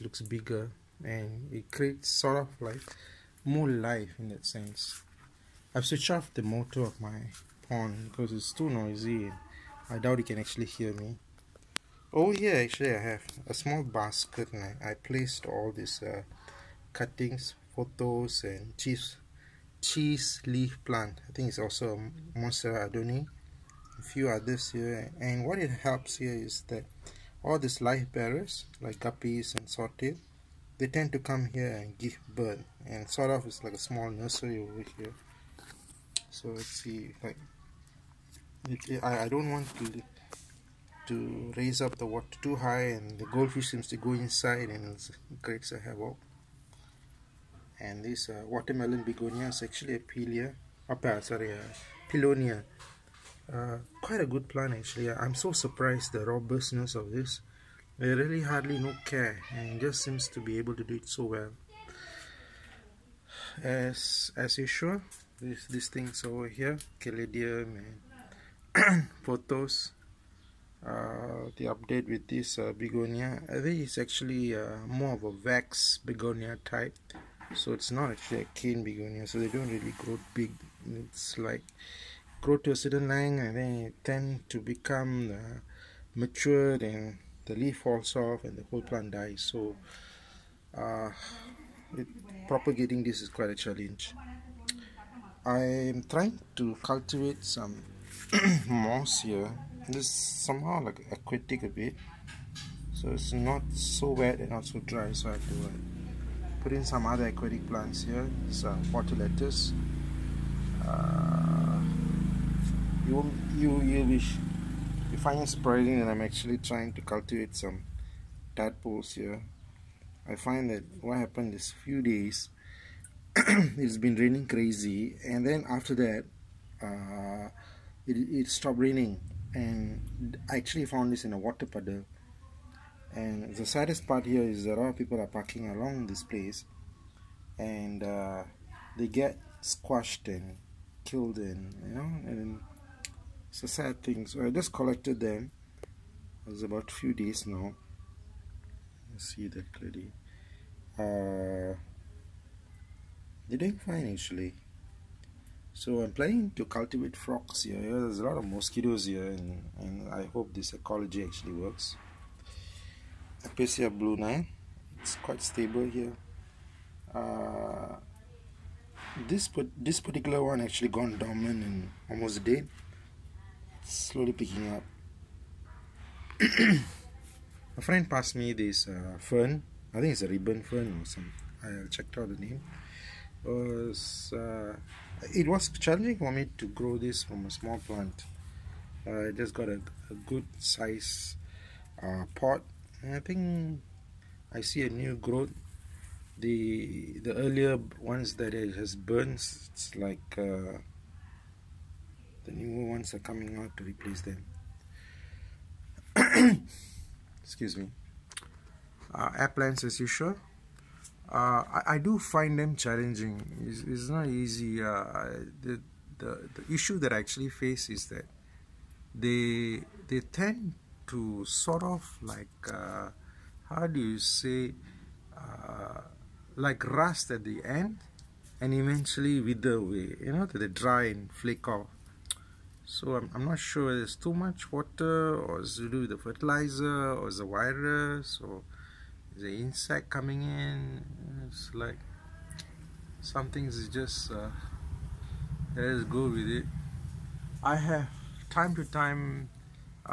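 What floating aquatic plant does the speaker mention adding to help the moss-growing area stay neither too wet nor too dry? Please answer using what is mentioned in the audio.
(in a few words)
Water lettuce.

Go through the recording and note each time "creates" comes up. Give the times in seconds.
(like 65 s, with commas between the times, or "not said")
1 s, 45 s.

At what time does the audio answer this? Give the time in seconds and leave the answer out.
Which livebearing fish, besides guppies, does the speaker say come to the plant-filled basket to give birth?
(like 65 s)
29 s.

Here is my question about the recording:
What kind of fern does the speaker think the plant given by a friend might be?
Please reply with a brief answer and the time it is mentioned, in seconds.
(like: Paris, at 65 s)
Ribbon fern, at 180 s.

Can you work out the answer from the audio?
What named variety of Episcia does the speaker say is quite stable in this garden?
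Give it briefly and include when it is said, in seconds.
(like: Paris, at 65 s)
Blue Nile, at 163 s.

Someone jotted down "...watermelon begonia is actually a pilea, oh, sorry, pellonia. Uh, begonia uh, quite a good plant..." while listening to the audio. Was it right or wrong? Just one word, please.
wrong.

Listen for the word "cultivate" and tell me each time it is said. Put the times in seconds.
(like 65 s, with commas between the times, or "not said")
96 s, 117 s, 156 s.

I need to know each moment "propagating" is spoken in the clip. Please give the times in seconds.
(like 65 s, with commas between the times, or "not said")
92 s.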